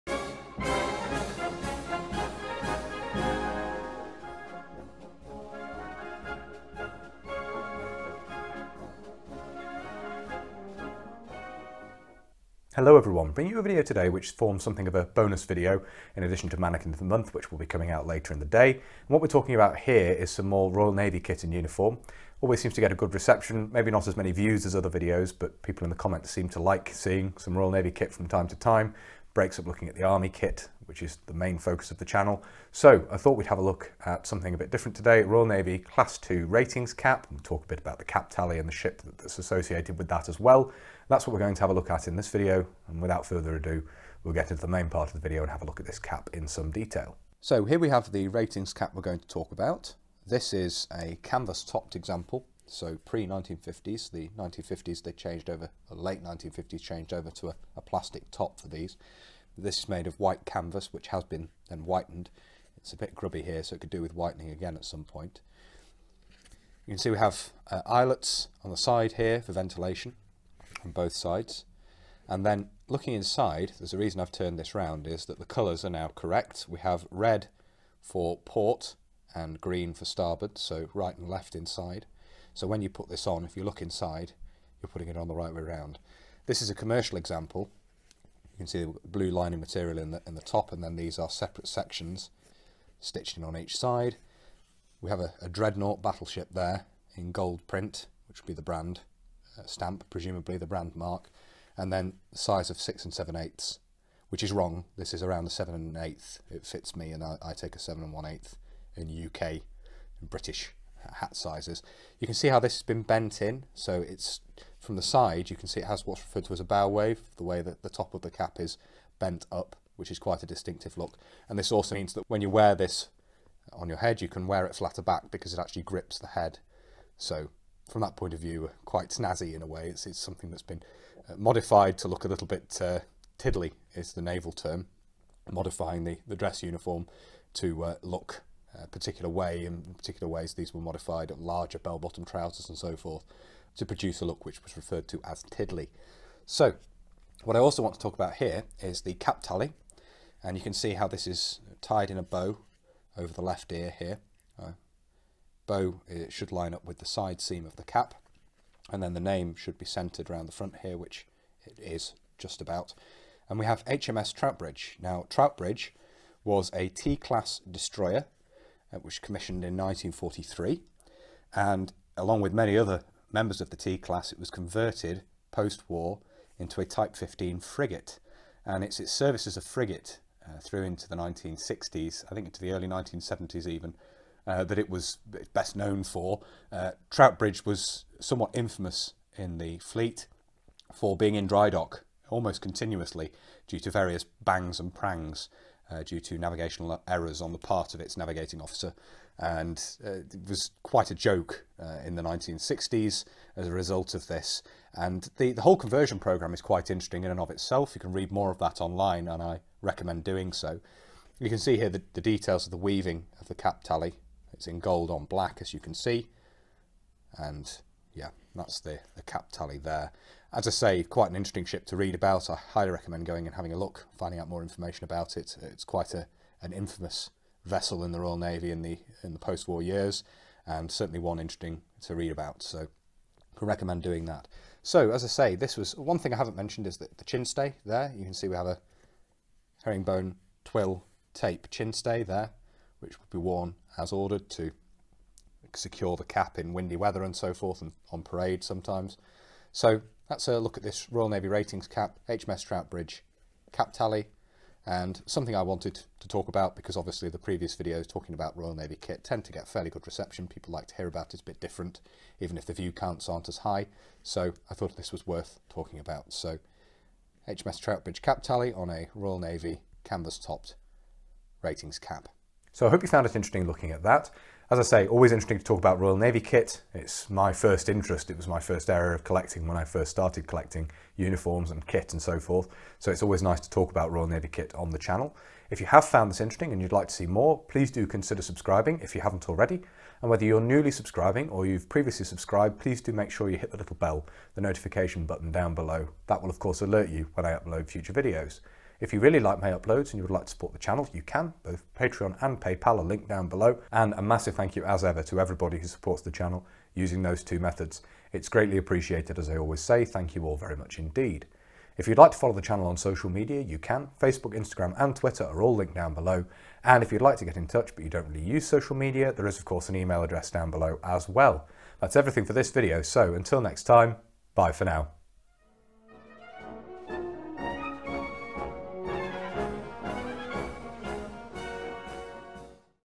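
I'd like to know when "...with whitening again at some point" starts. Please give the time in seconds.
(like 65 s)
64 s.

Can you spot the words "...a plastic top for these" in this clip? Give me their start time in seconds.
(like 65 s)
57 s.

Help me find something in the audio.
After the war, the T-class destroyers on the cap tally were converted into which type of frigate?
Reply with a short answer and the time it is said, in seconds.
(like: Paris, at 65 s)
Type 15, at 176 s.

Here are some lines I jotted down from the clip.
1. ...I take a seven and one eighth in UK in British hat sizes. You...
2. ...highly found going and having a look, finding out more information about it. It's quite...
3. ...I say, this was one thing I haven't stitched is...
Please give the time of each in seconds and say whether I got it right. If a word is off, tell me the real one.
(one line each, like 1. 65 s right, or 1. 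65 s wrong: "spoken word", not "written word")
1. 107 s right
2. 222 s wrong: "recommend", not "found"
3. 235 s wrong: "mentioned", not "stitched".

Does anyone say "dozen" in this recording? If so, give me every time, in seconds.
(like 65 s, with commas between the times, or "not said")
not said.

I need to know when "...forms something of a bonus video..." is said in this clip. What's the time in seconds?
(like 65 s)
14 s.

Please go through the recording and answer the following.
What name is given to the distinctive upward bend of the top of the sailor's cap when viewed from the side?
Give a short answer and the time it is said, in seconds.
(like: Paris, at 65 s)
bow wave, at 116 s.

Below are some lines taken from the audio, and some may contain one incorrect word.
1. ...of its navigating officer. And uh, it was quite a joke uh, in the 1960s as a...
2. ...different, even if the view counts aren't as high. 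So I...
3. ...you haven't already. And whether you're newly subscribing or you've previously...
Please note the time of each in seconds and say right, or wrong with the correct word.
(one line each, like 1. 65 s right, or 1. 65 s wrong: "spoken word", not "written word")
1. 197 s right
2. 261 s right
3. 289 s right.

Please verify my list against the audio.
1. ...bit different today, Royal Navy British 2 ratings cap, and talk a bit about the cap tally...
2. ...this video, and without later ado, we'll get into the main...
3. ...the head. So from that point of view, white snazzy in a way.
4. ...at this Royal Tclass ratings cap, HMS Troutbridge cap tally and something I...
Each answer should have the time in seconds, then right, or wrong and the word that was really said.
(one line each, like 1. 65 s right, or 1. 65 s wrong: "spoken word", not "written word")
1. 34 s wrong: "Class", not "British"
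2. 42 s wrong: "further", not "later"
3. 126 s wrong: "quite", not "white"
4. 250 s wrong: "Navy", not "Tclass".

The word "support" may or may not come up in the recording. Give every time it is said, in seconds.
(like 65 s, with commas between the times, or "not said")
300 s, 305 s.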